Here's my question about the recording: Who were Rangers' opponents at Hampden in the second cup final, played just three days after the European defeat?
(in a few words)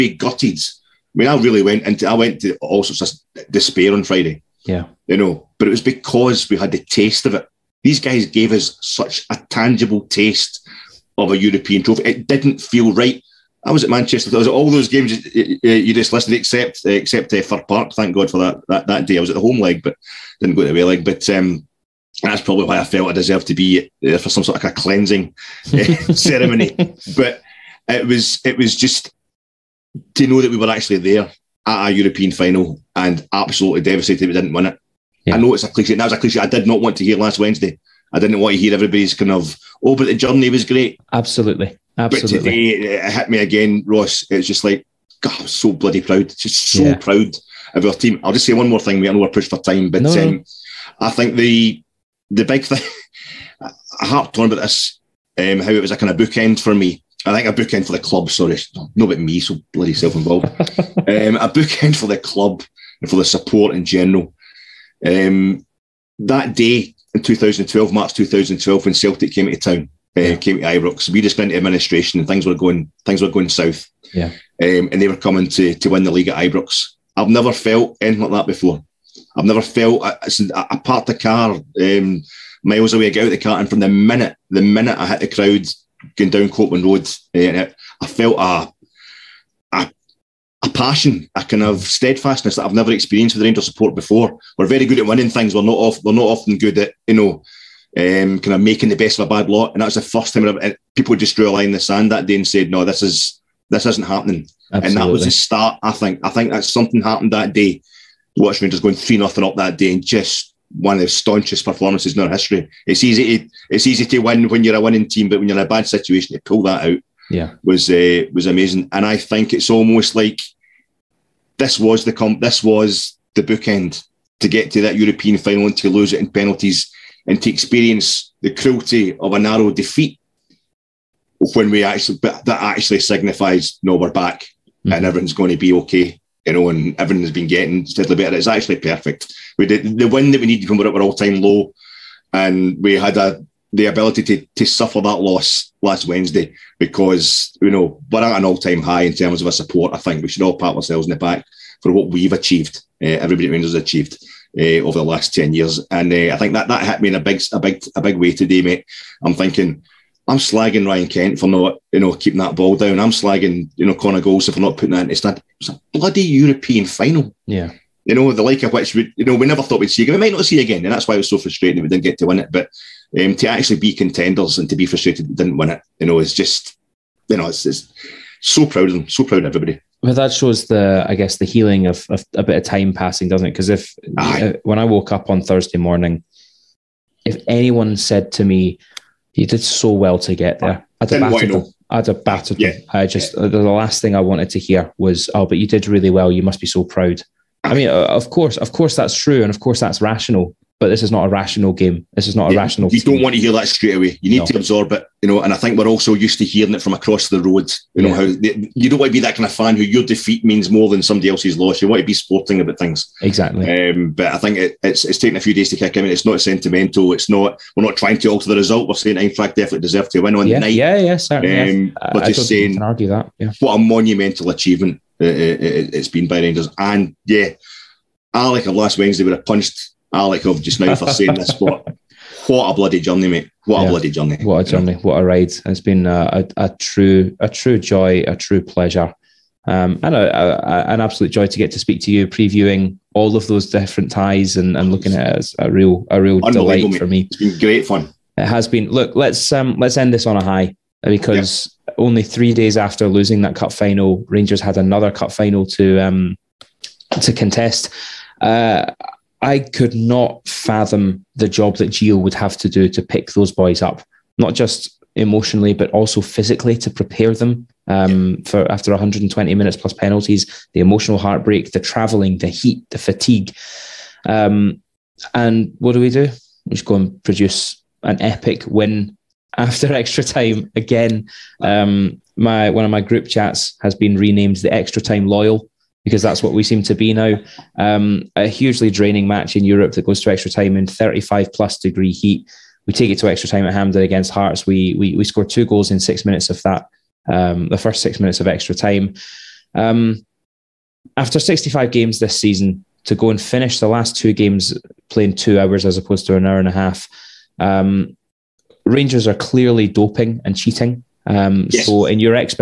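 Hearts.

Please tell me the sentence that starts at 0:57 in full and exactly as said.
I think a bookend for the club.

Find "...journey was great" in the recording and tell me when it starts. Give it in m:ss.
0:40.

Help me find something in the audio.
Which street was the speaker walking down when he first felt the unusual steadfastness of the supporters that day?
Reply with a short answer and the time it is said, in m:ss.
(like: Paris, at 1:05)
Copland Road, at 1:26.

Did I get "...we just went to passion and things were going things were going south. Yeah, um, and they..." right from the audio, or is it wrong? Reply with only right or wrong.
wrong.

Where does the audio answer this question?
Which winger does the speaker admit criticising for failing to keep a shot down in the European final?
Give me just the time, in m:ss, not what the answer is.
2:40.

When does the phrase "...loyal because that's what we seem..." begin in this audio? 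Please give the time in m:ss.
4:45.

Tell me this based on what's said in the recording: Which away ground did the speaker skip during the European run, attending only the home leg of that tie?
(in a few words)
Fir Park.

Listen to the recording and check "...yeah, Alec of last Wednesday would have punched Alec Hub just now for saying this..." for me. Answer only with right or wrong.
right.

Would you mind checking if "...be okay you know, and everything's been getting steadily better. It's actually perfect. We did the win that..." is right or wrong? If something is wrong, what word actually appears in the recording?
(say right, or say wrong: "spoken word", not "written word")
right.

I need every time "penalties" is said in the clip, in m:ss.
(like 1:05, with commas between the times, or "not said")
2:06, 4:29.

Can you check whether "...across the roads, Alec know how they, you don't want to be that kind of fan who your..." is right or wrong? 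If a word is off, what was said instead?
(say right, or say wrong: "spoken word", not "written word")
wrong: "You", not "Alec".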